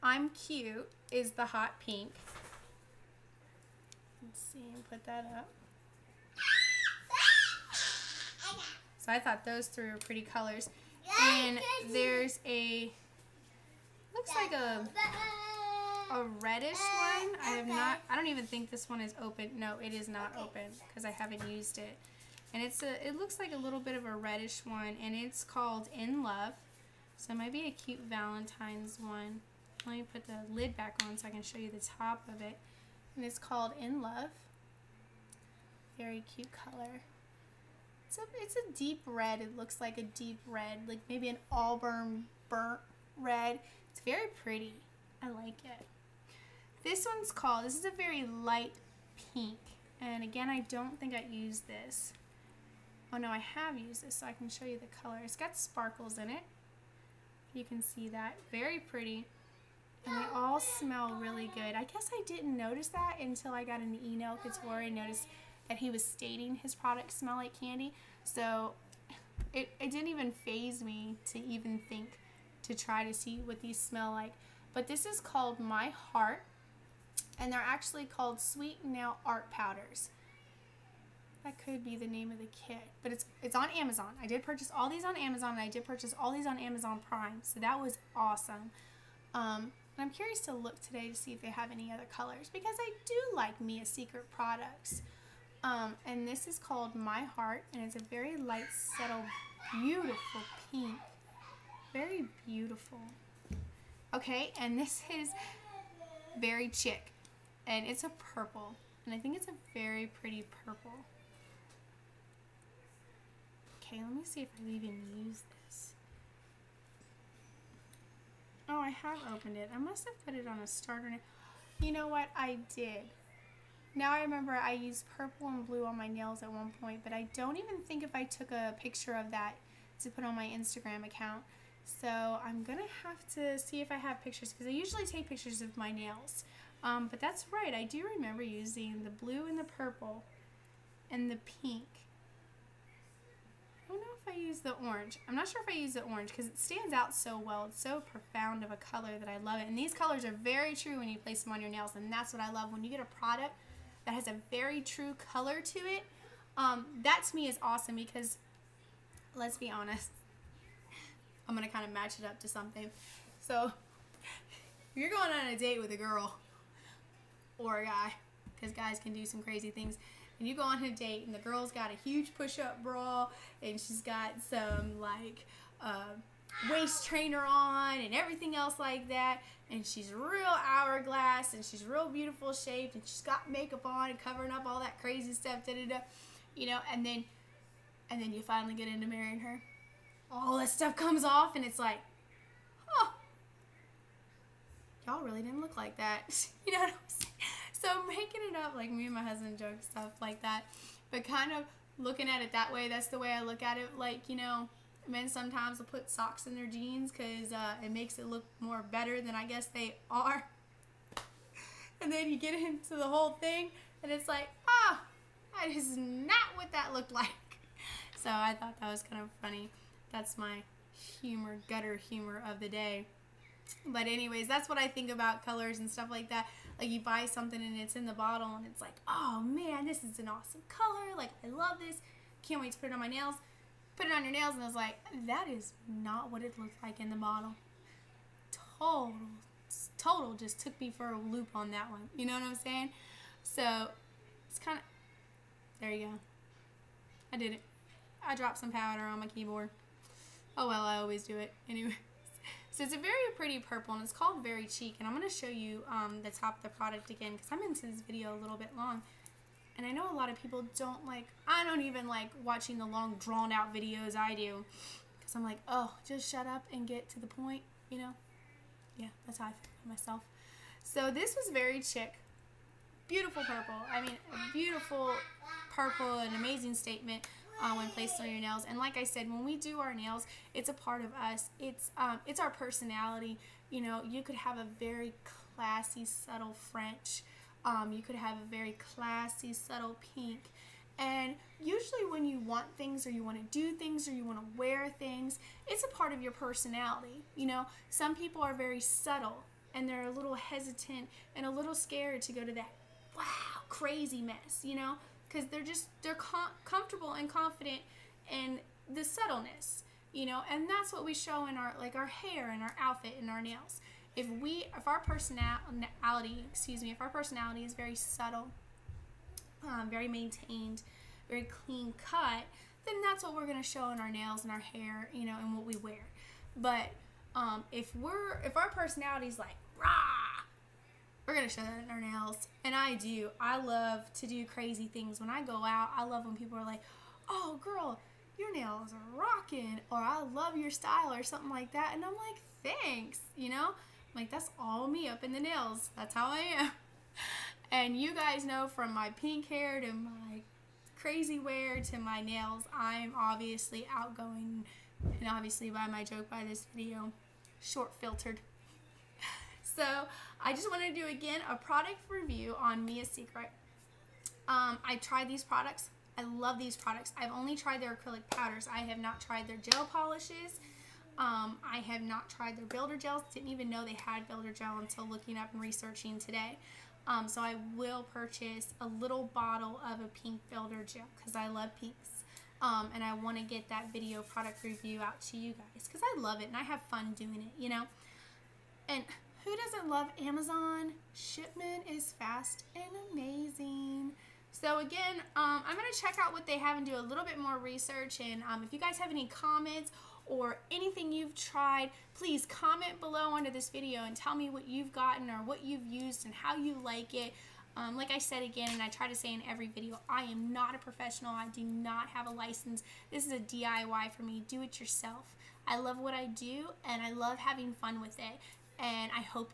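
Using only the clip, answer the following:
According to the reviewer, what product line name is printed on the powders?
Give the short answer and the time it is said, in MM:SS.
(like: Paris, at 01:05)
Sweet Now Art Powders, at 01:18.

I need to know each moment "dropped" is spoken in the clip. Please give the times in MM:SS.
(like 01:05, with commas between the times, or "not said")
04:08.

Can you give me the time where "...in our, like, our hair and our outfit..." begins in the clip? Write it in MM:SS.
05:11.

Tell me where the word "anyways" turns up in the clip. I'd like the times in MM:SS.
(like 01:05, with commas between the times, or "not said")
03:44, 04:11.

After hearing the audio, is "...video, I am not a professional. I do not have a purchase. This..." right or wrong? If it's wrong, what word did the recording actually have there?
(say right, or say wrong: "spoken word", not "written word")
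wrong: "license", not "purchase".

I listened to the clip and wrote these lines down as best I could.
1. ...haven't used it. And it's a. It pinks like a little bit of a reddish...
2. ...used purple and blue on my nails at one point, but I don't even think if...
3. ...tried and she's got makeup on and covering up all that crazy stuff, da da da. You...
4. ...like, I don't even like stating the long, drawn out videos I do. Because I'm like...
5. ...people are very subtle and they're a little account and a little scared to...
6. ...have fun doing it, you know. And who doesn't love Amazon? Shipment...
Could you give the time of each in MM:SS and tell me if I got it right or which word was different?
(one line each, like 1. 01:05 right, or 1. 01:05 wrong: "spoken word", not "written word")
1. 00:21 wrong: "looks", not "pinks"
2. 02:04 right
3. 03:02 wrong: "shaped", not "tried"
4. 04:21 wrong: "watching", not "stating"
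5. 04:58 wrong: "hesitant", not "account"
6. 06:26 right.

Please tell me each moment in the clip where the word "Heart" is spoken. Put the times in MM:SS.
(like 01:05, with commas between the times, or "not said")
01:15, 01:37.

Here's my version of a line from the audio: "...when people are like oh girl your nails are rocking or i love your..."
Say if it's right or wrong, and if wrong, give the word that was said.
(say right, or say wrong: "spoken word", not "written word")
right.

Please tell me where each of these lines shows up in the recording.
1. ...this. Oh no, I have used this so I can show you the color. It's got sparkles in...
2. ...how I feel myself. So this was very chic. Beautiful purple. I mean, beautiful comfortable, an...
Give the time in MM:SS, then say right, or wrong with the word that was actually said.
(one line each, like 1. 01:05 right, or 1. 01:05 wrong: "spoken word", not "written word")
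1. 00:51 right
2. 04:29 wrong: "purple", not "comfortable".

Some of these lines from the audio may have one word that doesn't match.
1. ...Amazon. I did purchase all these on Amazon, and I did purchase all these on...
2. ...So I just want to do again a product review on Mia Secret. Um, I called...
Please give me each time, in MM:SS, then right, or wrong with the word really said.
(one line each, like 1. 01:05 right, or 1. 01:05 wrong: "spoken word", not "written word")
1. 01:23 right
2. 05:59 wrong: "tried", not "called".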